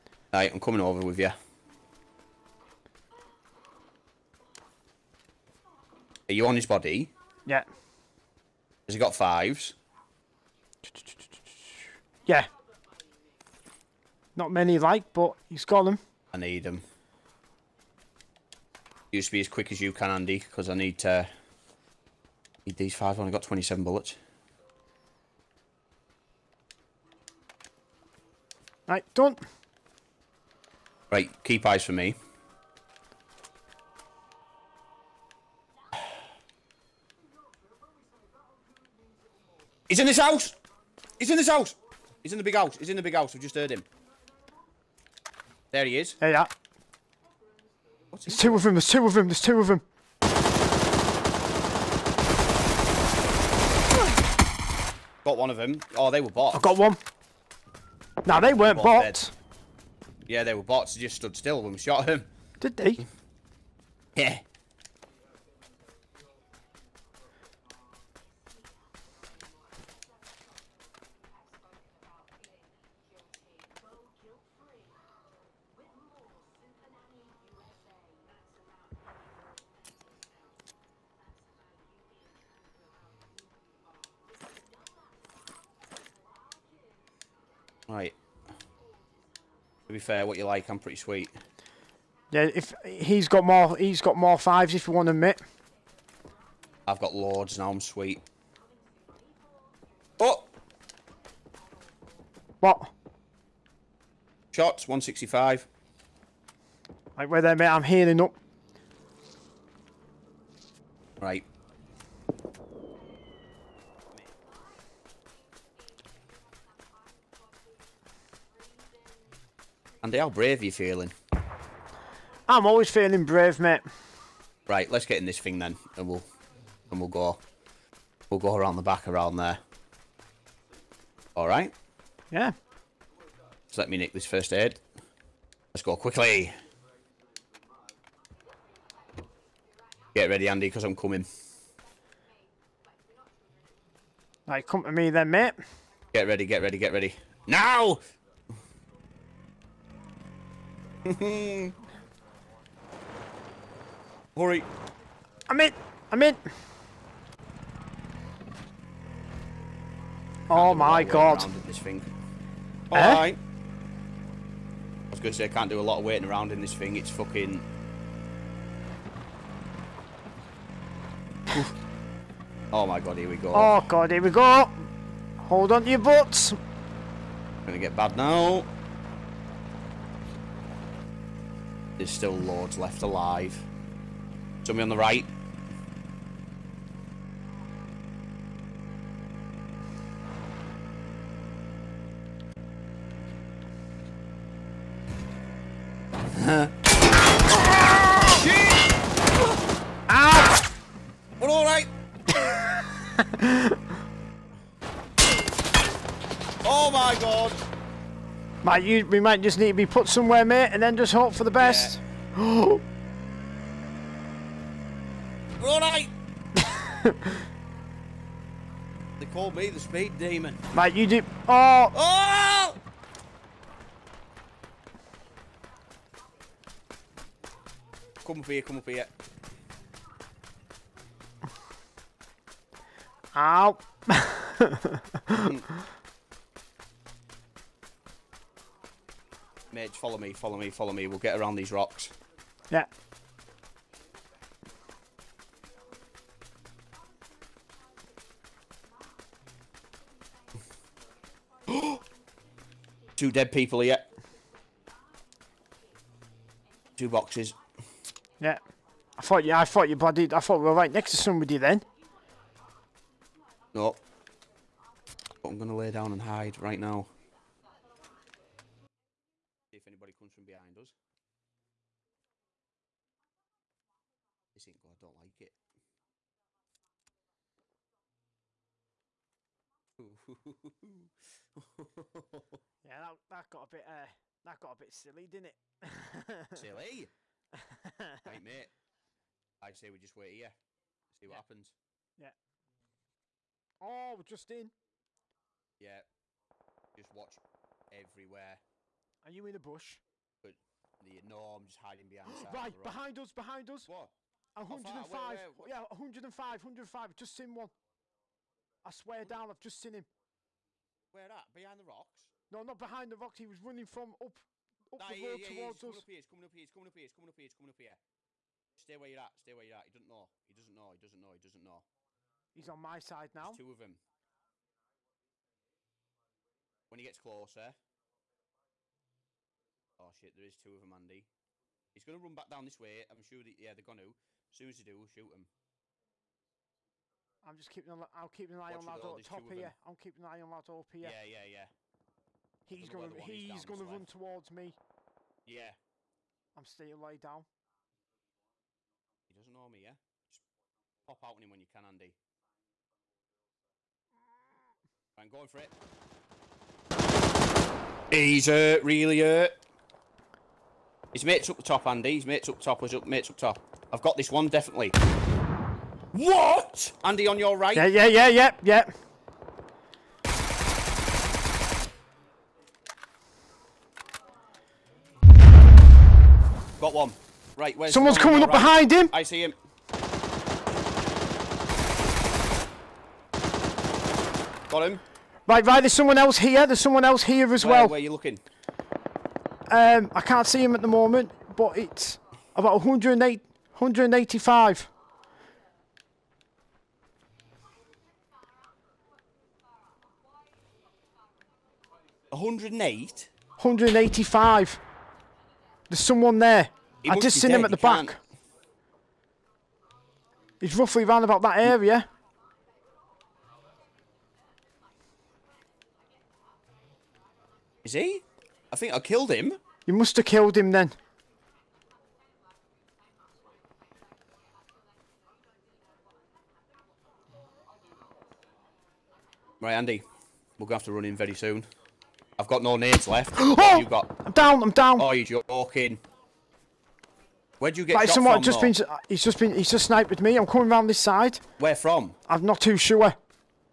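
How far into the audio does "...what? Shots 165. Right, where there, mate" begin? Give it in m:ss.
1:42.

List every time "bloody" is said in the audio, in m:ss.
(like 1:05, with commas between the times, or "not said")
4:19.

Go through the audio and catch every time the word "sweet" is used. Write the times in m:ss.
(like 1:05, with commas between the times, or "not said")
1:30, 1:37.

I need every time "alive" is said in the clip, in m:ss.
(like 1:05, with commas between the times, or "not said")
3:03.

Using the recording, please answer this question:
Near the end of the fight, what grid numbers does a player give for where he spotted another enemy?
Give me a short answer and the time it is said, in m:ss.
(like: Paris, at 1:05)
108, 185, at 6:32.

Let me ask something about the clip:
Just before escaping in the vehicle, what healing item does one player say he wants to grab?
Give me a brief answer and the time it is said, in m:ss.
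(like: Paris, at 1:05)
first aid, at 2:14.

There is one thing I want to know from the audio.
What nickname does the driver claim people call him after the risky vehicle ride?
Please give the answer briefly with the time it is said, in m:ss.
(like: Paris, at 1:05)
the speed demon, at 3:39.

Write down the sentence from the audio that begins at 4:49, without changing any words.
I say we just wait here, see what yeah.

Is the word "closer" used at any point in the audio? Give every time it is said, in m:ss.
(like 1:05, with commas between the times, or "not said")
5:27.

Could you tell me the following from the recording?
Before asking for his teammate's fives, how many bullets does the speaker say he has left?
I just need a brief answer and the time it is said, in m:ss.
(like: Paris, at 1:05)
27, at 0:23.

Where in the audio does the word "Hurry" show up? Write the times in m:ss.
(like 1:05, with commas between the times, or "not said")
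2:31.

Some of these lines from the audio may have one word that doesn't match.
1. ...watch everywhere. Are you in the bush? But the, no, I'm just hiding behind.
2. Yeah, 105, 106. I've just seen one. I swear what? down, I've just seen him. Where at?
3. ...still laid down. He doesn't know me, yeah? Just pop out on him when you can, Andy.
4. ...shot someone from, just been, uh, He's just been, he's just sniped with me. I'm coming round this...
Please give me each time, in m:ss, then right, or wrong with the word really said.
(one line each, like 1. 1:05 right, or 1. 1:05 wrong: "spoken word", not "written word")
1. 4:57 right
2. 5:05 wrong: "105", not "106"
3. 5:46 right
4. 7:18 right.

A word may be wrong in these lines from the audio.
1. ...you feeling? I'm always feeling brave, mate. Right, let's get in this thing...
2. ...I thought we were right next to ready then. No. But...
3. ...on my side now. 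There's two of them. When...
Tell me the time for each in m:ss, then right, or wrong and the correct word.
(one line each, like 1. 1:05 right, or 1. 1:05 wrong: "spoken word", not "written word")
1. 2:00 right
2. 4:20 wrong: "somebody", not "ready"
3. 5:22 right.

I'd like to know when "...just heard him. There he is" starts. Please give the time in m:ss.
0:43.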